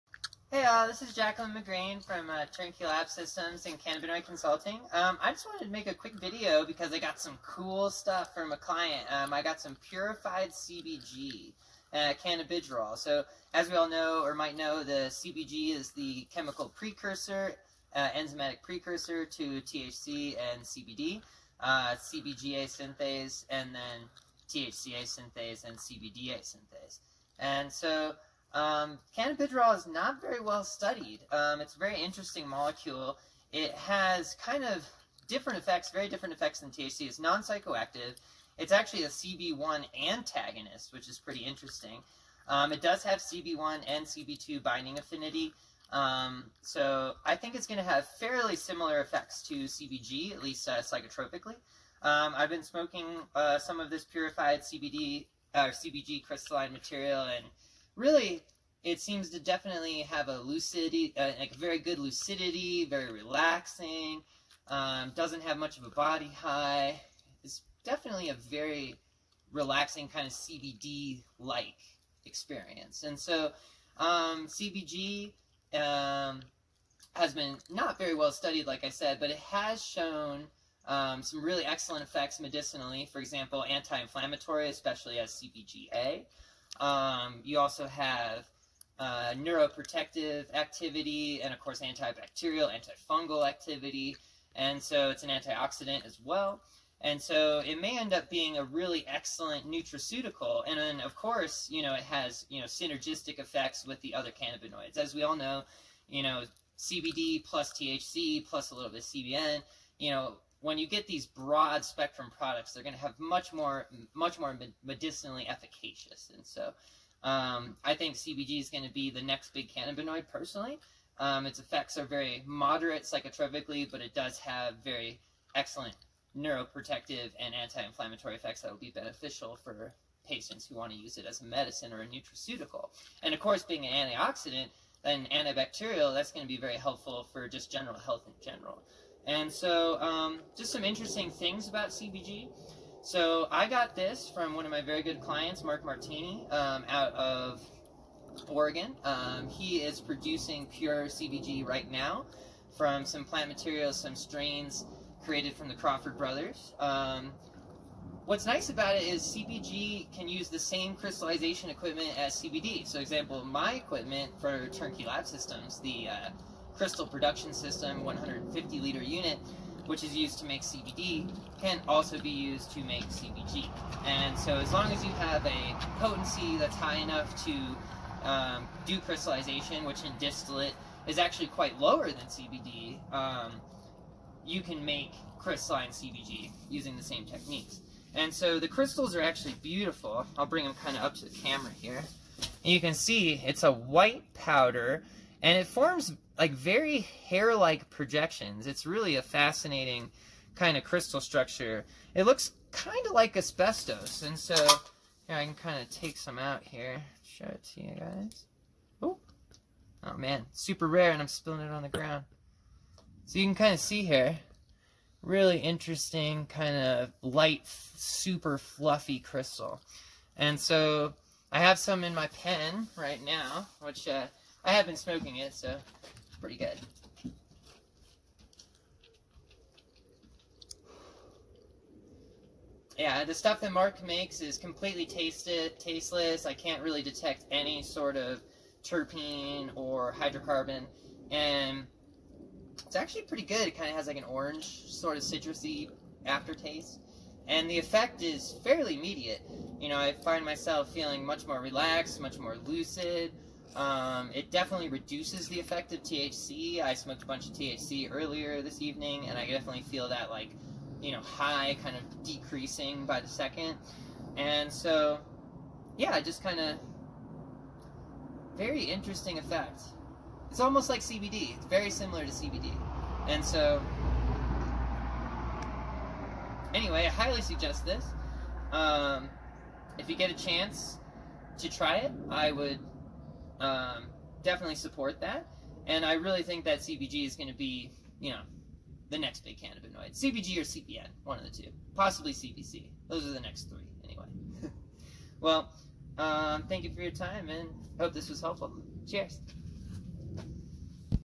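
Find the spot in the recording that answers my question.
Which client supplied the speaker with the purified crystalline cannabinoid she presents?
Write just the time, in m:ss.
2:25.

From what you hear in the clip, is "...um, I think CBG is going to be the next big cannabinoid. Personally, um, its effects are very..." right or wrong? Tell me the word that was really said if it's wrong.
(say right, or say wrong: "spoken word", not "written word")
right.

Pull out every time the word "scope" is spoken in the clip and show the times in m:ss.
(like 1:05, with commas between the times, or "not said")
not said.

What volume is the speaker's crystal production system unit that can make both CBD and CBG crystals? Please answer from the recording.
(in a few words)
150 liters.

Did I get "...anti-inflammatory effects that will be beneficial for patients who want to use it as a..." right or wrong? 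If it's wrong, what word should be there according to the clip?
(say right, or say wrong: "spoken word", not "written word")
right.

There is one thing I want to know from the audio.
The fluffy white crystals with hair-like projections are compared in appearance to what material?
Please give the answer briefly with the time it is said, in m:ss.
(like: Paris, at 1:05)
asbestos, at 3:23.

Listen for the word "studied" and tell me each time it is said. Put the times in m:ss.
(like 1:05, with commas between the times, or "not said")
0:30, 1:18.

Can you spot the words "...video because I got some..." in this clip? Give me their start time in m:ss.
0:06.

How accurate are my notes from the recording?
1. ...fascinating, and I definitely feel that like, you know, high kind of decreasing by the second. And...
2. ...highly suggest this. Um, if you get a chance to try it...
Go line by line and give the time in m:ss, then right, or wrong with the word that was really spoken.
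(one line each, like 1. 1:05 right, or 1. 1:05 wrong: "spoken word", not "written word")
1. 4:18 wrong: "evening", not "fascinating"
2. 4:37 right.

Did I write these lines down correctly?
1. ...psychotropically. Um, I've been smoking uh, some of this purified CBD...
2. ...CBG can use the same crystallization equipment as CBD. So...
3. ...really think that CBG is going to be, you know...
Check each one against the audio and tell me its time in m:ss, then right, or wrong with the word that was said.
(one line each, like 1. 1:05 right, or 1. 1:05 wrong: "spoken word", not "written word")
1. 0:50 right
2. 2:39 right
3. 4:46 right.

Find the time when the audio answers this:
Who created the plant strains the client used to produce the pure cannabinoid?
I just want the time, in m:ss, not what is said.
2:35.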